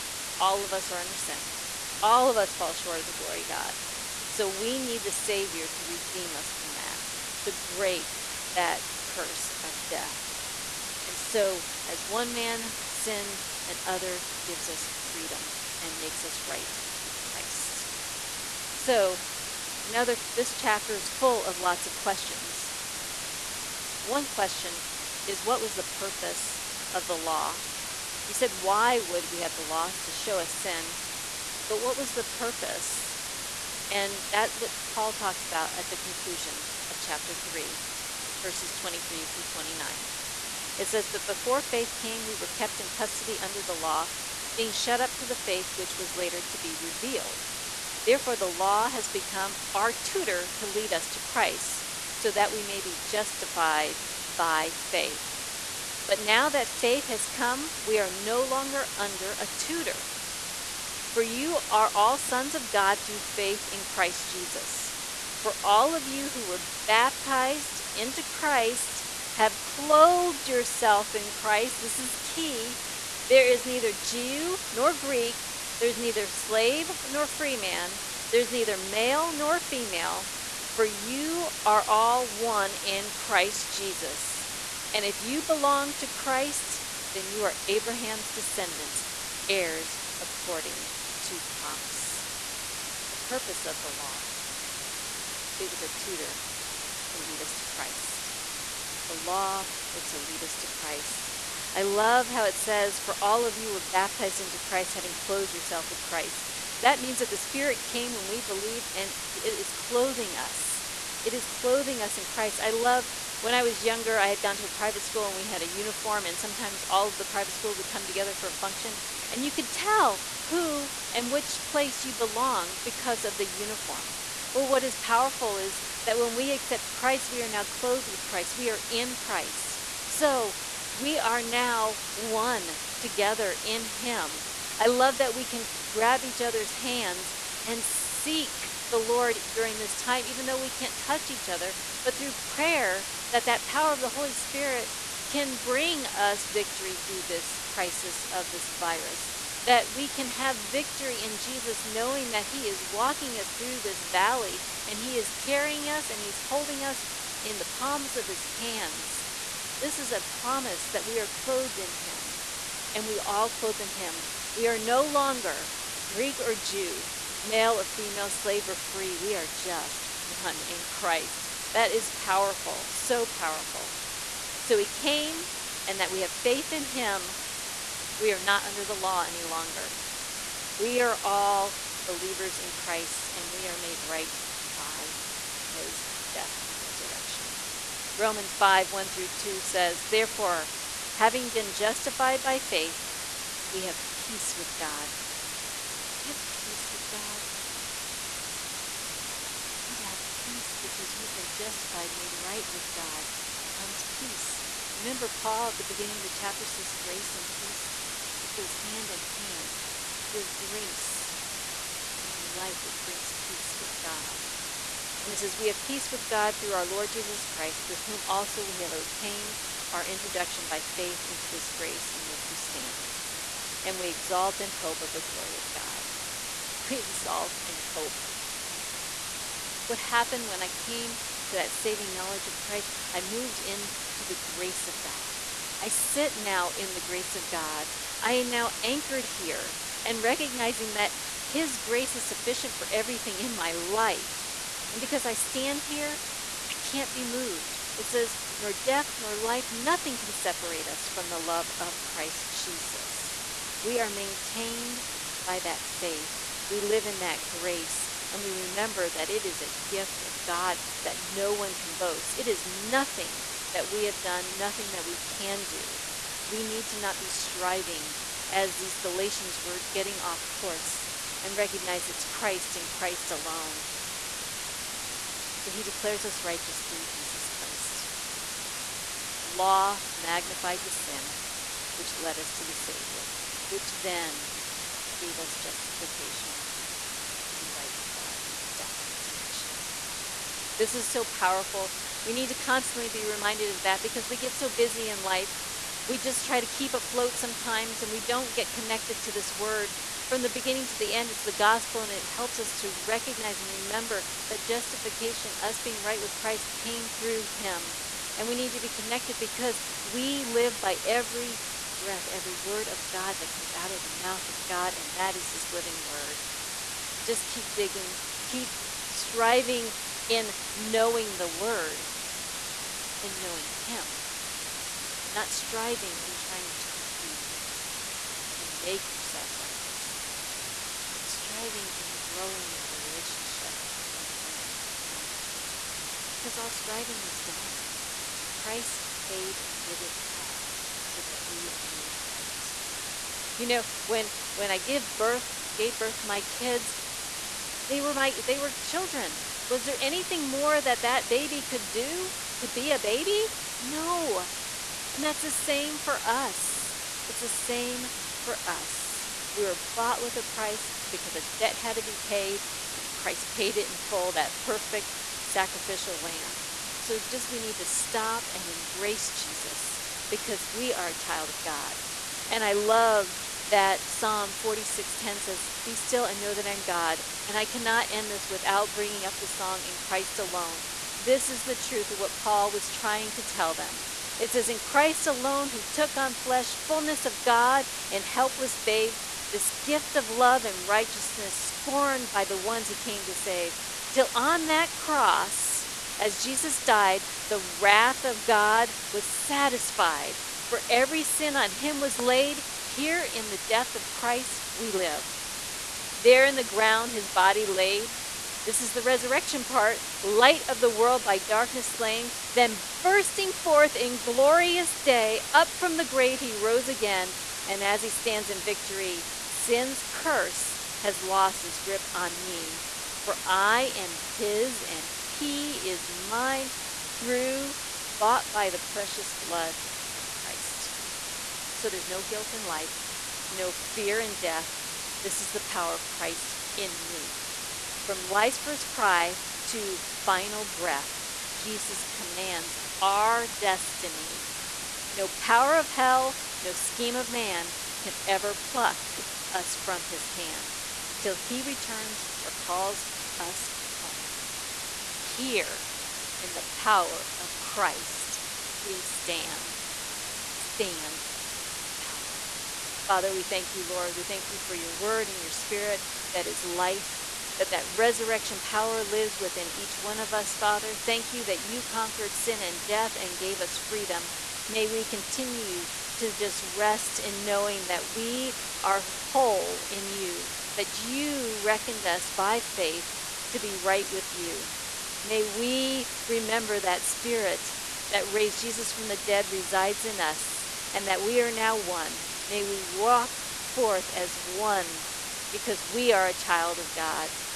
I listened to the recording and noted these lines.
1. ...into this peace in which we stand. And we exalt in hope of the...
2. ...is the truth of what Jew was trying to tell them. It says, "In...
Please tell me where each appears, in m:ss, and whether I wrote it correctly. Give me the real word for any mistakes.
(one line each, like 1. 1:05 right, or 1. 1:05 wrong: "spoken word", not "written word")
1. 3:41 wrong: "grace", not "peace"
2. 6:21 wrong: "Paul", not "Jew".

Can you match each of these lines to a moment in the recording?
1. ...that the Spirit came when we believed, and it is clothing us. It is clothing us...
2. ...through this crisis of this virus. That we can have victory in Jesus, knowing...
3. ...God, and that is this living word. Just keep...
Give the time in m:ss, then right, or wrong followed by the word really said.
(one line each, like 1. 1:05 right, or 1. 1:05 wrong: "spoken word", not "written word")
1. 1:47 right
2. 2:26 right
3. 5:14 right.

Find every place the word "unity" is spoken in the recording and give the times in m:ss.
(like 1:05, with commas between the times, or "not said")
not said.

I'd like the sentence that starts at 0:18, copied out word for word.
So, another this chapter is full of lots of questions.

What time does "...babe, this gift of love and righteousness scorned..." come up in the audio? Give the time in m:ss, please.
6:28.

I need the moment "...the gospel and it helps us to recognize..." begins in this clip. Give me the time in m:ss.
5:01.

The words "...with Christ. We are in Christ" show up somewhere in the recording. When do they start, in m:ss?
2:08.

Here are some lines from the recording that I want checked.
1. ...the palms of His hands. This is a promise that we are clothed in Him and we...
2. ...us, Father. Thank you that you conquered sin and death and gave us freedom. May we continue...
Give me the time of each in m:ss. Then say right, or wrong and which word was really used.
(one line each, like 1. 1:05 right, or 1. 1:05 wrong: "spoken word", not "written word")
1. 2:37 right
2. 7:50 right.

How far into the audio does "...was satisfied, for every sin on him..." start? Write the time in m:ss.
6:39.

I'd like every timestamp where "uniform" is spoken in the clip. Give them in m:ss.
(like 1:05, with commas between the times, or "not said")
1:55, 2:03.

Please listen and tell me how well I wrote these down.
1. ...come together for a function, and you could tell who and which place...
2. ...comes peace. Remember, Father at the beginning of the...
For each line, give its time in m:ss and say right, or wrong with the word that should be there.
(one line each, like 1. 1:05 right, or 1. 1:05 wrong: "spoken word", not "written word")
1. 1:57 right
2. 3:23 wrong: "Paul", not "Father".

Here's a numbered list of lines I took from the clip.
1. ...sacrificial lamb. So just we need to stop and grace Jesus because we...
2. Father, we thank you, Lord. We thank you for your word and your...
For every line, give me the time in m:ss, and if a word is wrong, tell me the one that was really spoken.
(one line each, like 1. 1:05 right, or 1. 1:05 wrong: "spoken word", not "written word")
1. 6:05 wrong: "embrace", not "grace"
2. 7:43 right.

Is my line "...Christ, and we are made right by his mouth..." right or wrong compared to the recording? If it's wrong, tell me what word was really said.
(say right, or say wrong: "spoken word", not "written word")
wrong: "death", not "mouth".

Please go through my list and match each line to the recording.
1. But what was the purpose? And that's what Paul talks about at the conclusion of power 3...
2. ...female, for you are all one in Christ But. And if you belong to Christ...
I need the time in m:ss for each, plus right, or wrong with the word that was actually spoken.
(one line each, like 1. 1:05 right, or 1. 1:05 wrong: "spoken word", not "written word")
1. 0:31 wrong: "chapter", not "power"
2. 1:19 wrong: "Jesus", not "But".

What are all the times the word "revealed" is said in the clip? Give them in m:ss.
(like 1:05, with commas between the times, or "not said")
0:46.